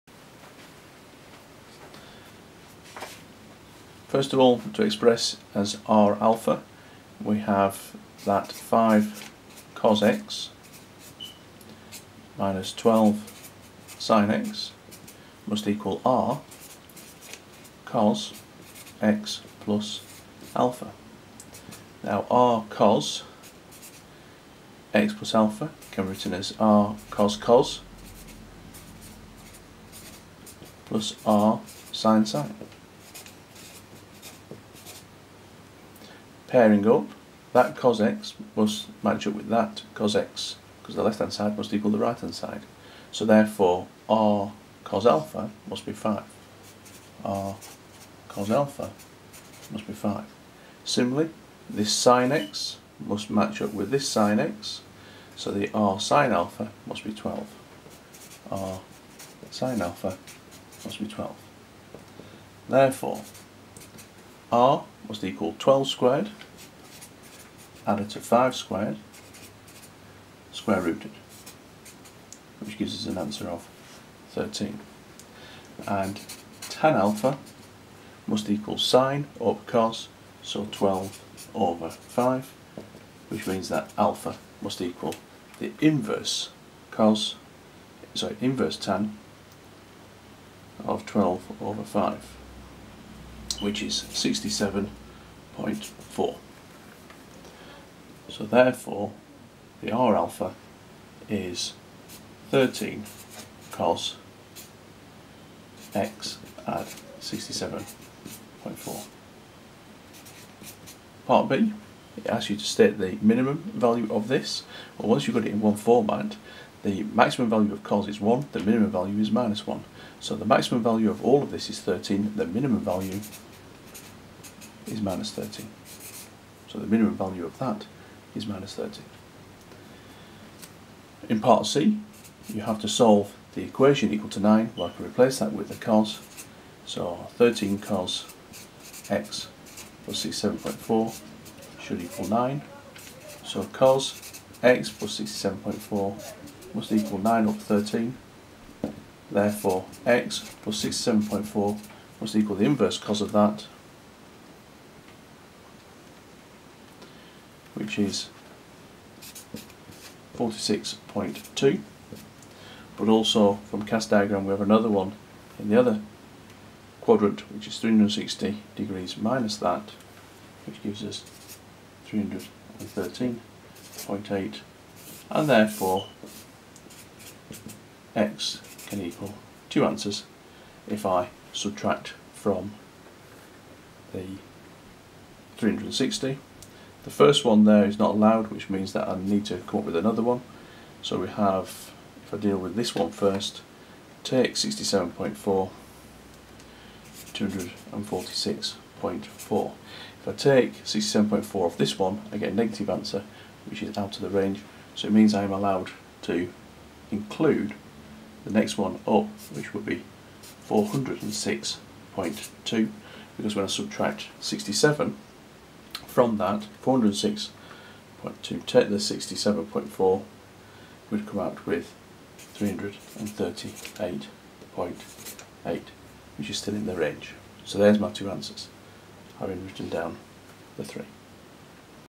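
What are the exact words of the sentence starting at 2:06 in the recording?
So the minimum value of that is minus 30.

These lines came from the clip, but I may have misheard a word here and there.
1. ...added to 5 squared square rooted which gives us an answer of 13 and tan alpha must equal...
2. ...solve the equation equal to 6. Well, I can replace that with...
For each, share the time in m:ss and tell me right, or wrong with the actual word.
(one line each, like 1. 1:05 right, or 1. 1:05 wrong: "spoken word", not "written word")
1. 1:07 right
2. 2:12 wrong: "9", not "6".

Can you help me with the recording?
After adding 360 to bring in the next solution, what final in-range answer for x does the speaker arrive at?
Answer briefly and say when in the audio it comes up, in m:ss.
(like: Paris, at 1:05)
338.8, at 3:42.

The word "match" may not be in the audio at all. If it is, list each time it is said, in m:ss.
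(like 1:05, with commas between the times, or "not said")
0:39, 0:53.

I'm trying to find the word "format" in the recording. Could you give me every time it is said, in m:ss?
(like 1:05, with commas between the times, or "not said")
1:55.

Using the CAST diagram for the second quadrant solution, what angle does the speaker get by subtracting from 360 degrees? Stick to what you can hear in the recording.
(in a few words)
313.8.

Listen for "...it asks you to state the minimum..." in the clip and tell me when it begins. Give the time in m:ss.
1:52.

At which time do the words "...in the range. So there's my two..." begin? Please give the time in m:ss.
3:46.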